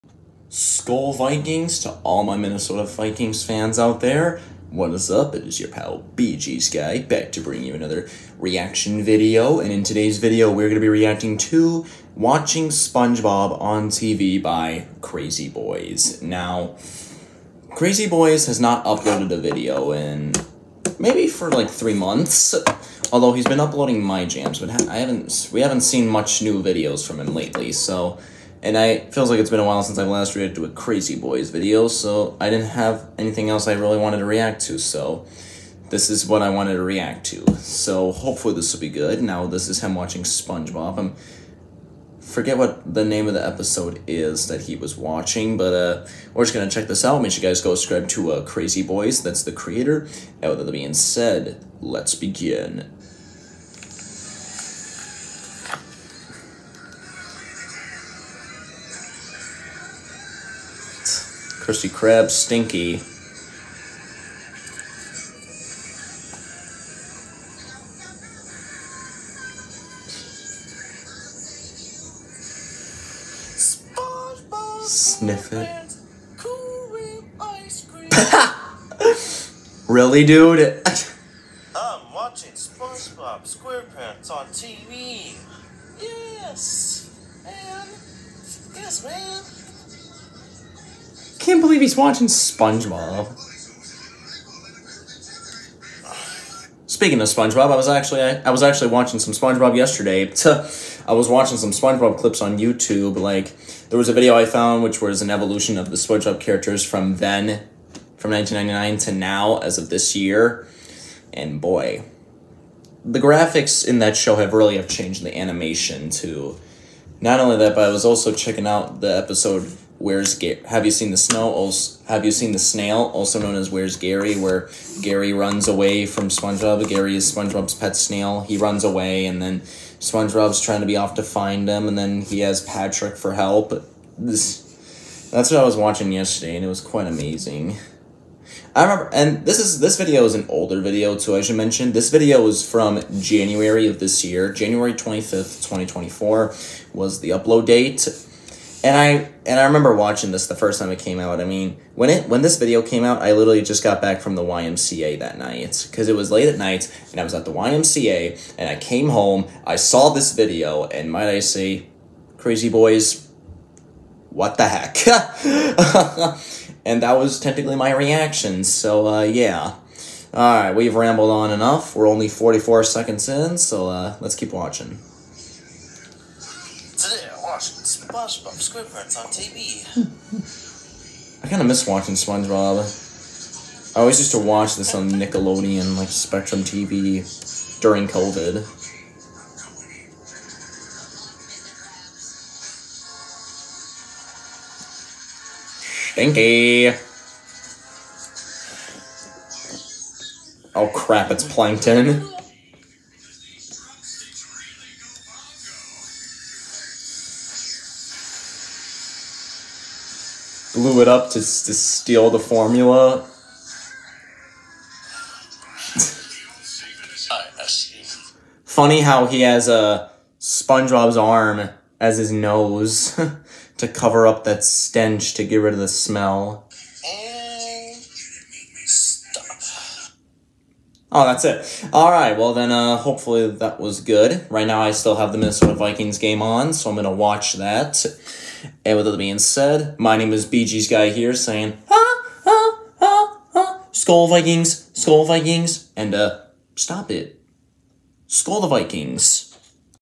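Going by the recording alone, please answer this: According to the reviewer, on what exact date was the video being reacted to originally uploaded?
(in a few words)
January 25, 2024.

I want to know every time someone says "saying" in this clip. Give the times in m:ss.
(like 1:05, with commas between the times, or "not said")
4:01.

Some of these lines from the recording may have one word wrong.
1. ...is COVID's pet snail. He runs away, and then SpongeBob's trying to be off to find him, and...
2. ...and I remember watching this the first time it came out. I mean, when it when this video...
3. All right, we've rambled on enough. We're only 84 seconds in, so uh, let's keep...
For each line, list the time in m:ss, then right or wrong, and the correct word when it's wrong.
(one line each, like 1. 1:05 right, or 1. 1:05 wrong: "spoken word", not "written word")
1. 2:07 wrong: "SpongeBob", not "COVID"
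2. 2:29 right
3. 2:50 wrong: "44", not "84".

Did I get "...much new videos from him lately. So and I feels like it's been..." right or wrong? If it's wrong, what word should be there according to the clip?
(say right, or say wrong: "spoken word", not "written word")
right.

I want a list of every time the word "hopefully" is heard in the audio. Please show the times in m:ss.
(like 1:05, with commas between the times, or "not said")
0:38, 3:52.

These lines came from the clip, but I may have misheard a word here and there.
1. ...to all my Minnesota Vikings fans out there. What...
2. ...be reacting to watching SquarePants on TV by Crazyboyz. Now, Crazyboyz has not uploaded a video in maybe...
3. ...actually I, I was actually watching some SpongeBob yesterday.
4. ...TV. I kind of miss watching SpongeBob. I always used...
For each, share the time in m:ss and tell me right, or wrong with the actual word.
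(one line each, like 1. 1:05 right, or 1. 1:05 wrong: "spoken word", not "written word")
1. 0:01 right
2. 0:10 wrong: "SpongeBob", not "SquarePants"
3. 1:37 right
4. 2:59 right.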